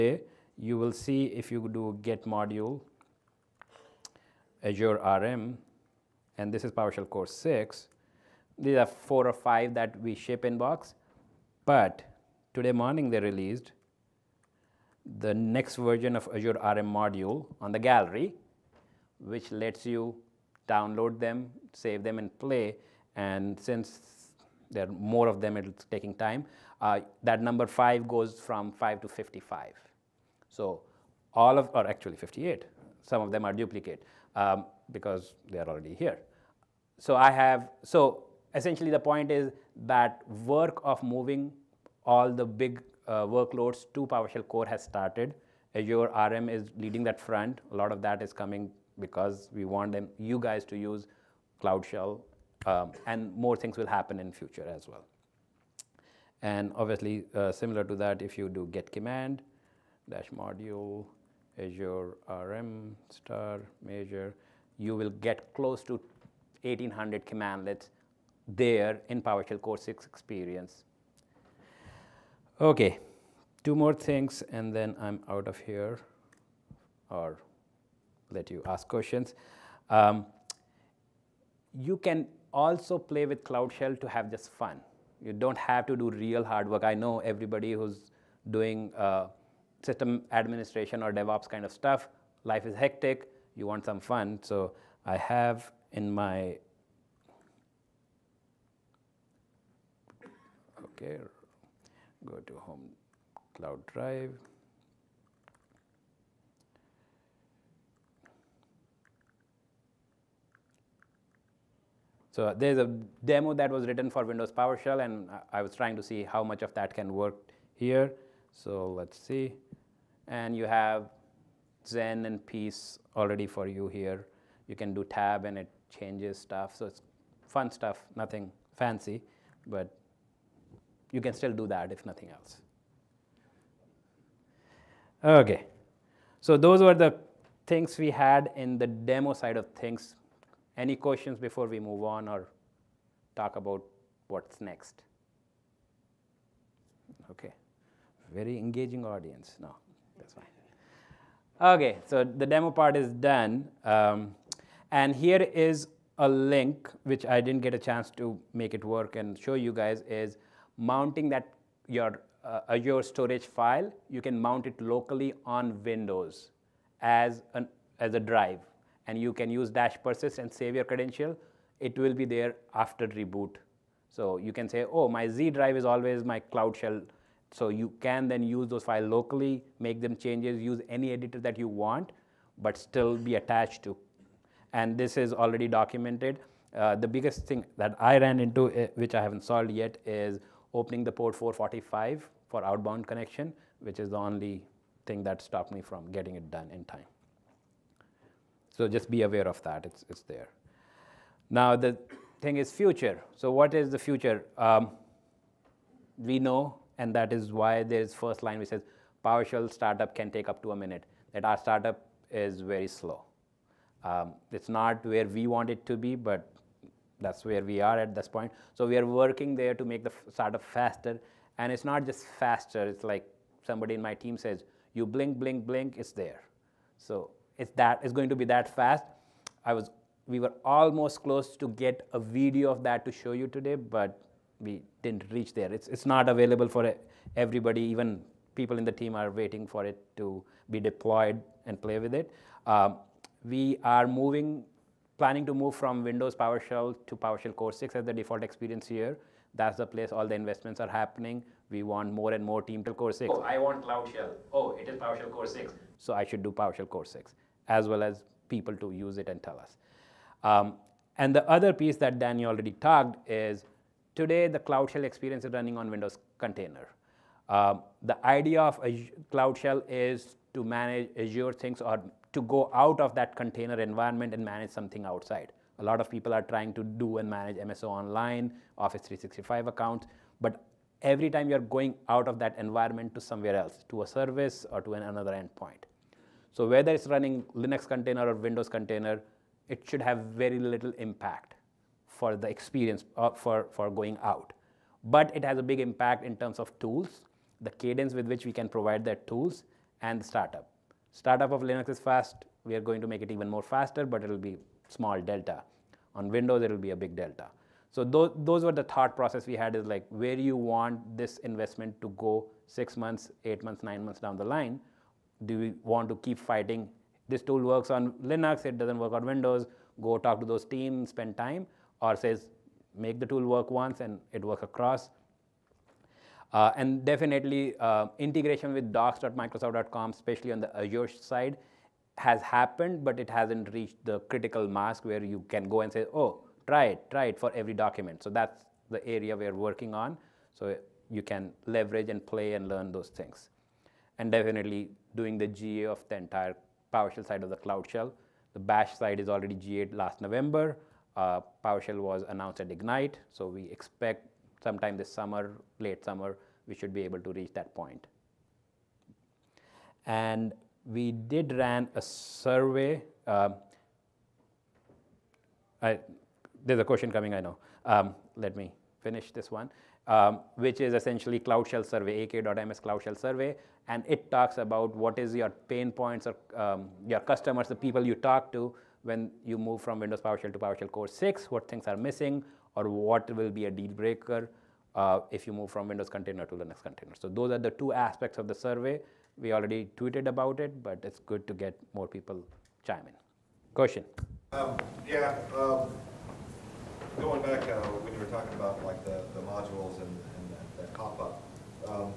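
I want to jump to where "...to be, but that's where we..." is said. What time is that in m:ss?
3:35.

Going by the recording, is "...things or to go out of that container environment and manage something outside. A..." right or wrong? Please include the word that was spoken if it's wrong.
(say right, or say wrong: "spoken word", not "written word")
right.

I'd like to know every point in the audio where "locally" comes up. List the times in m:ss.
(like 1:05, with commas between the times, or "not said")
2:44, 2:59.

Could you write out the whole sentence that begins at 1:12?
Okay, two more things and then I'm out of here or let you ask questions.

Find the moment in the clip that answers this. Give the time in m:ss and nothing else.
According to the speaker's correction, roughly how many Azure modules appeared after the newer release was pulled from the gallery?
0:32.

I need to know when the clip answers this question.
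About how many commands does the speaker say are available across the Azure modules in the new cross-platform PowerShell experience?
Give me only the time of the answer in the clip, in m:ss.
1:06.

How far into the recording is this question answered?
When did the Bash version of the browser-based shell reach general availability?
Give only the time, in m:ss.
5:49.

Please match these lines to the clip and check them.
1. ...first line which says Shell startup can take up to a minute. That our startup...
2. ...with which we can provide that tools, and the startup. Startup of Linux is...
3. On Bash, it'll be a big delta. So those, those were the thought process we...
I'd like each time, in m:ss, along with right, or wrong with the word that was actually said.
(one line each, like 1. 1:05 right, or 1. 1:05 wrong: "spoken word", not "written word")
1. 3:28 wrong: "PowerShell", not "Shell"
2. 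4:58 right
3. 5:06 wrong: "Windows", not "Bash".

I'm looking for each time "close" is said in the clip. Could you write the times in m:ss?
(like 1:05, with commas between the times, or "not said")
1:05, 3:51.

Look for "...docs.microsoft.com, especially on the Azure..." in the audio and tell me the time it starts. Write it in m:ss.
5:28.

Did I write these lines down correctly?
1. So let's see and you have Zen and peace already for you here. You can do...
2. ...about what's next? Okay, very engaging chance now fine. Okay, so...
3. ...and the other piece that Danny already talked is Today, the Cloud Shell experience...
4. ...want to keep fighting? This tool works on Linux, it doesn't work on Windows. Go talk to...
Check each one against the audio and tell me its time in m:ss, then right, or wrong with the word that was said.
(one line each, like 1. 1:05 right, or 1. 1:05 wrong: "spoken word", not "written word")
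1. 1:58 right
2. 2:23 wrong: "audience", not "chance"
3. 4:21 right
4. 5:15 right.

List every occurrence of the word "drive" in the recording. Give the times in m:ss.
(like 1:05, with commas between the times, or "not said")
1:43, 2:48, 2:55.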